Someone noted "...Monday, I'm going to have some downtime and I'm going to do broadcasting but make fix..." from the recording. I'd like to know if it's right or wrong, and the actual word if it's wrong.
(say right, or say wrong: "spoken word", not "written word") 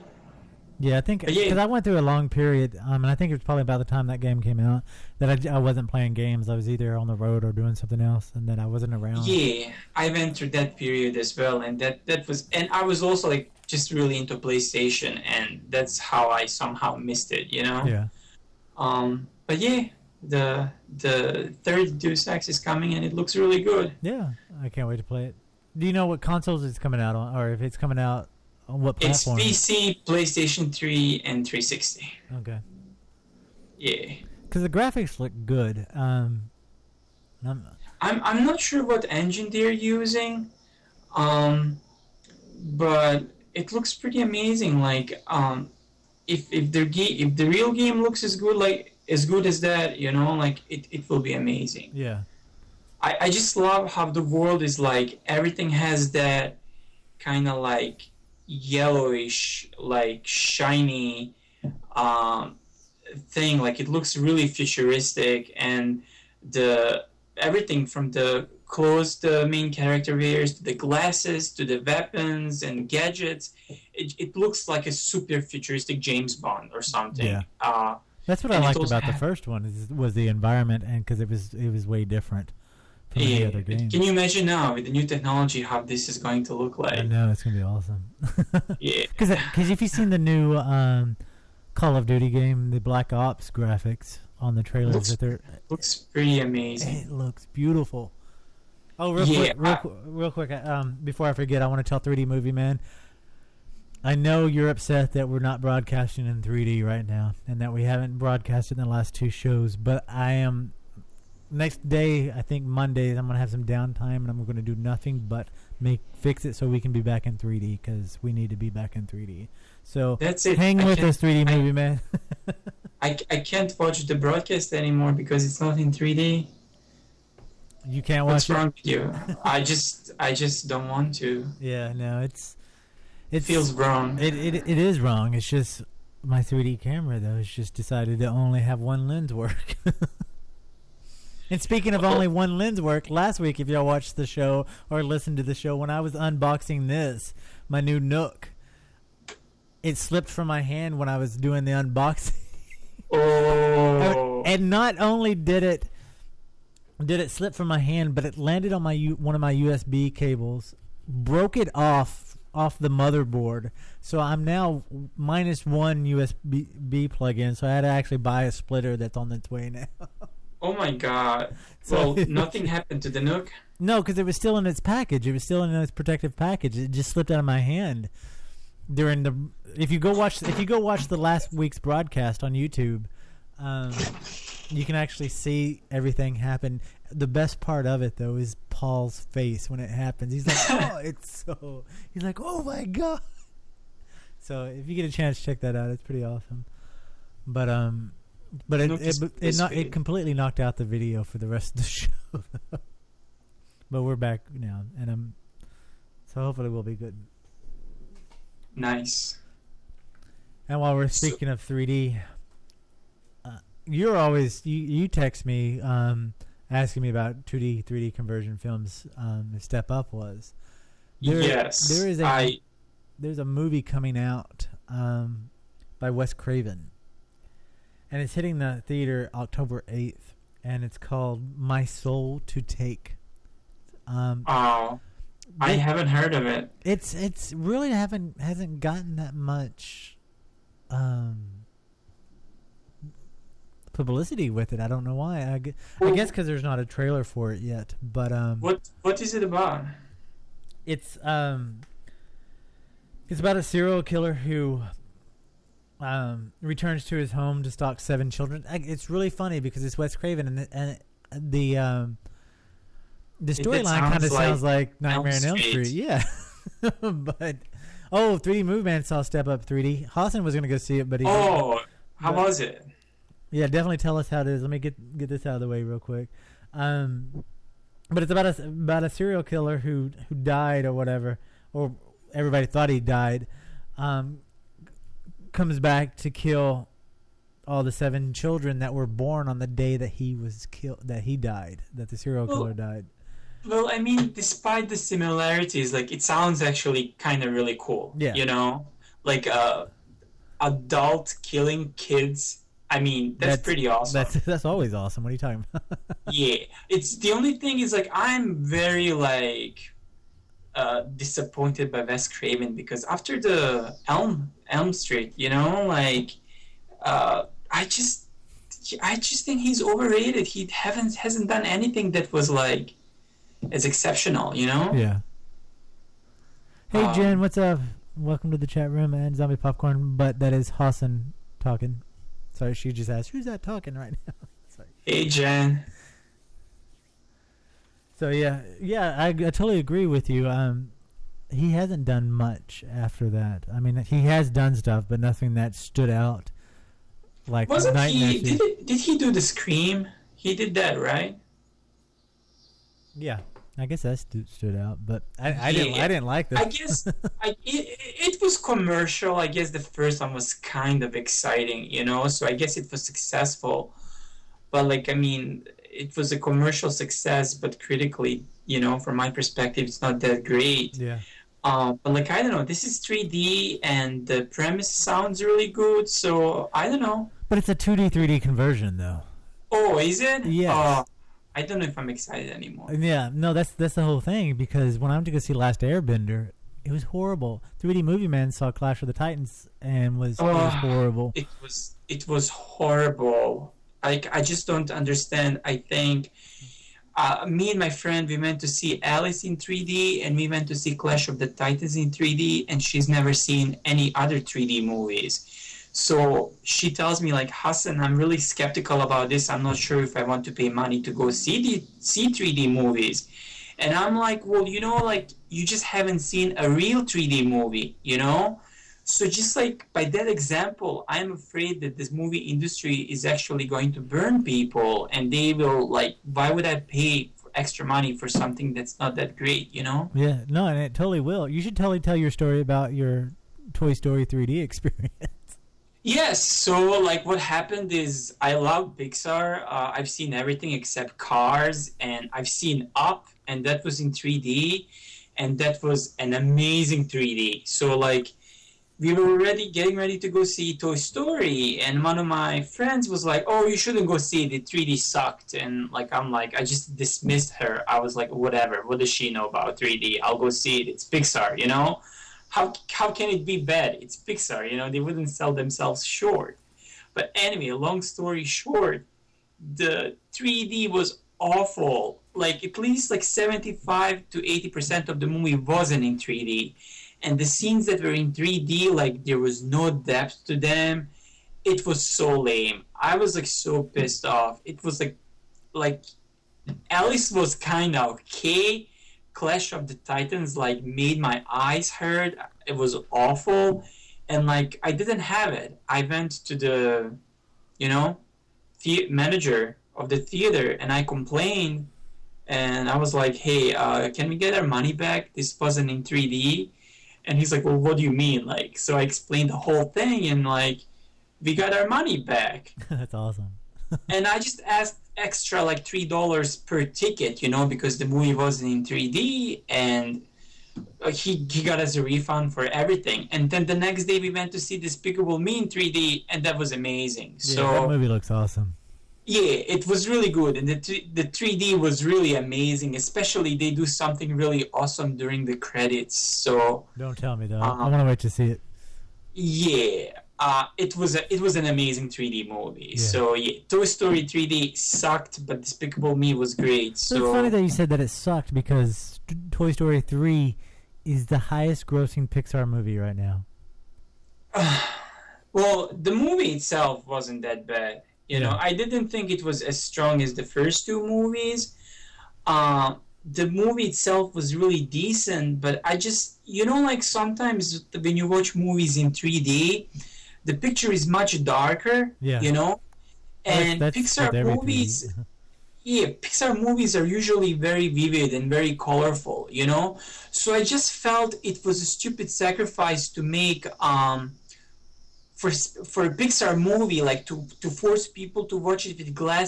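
wrong: "nothing", not "broadcasting".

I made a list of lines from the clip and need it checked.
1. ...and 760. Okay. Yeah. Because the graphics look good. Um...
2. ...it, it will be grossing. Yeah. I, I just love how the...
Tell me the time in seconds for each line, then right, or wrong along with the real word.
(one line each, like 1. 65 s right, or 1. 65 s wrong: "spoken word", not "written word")
1. 31 s wrong: "360", not "760"
2. 50 s wrong: "amazing", not "grossing".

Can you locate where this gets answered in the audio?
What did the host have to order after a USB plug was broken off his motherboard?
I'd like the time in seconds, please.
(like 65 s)
168 s.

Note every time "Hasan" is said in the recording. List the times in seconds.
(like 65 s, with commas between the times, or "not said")
270 s, 330 s, 407 s.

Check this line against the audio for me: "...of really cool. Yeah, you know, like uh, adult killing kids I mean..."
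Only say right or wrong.
right.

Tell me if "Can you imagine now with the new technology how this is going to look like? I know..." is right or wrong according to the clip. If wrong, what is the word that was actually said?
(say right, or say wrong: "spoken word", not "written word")
right.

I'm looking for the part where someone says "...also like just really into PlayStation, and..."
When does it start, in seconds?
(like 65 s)
13 s.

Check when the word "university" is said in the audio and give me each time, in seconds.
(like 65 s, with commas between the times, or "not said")
not said.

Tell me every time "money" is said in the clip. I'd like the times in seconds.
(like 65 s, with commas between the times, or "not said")
410 s, 427 s, 504 s, 511 s.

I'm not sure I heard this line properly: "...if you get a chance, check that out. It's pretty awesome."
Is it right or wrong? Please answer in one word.
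right.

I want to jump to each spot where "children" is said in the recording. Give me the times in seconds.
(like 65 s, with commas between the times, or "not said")
258 s, 288 s.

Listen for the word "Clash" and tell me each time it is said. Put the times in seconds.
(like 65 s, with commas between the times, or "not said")
388 s, 400 s, 489 s.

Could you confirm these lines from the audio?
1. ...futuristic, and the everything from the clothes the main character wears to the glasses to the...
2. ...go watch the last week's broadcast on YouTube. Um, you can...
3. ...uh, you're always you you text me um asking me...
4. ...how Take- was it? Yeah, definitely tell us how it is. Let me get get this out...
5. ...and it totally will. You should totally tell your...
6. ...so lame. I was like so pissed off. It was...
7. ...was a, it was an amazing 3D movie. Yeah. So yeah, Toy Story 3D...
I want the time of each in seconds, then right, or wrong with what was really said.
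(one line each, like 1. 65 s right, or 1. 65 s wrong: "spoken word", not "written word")
1. 64 s right
2. 180 s right
3. 213 s right
4. 272 s wrong: "But", not "Take"
5. 430 s right
6. 482 s right
7. 540 s right.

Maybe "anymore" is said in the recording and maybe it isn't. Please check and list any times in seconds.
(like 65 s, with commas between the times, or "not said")
124 s, 382 s.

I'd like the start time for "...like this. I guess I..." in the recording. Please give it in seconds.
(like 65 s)
356 s.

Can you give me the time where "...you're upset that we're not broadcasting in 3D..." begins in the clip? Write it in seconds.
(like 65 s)
104 s.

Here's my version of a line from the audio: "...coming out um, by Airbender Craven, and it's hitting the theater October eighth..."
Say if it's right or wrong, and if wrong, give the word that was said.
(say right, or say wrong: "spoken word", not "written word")
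wrong: "Wes", not "Airbender".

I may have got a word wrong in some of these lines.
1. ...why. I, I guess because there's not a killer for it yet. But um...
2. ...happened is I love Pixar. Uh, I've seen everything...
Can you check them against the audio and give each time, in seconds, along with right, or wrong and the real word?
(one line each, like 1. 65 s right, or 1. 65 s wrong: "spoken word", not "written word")
1. 245 s wrong: "trailer", not "killer"
2. 437 s right.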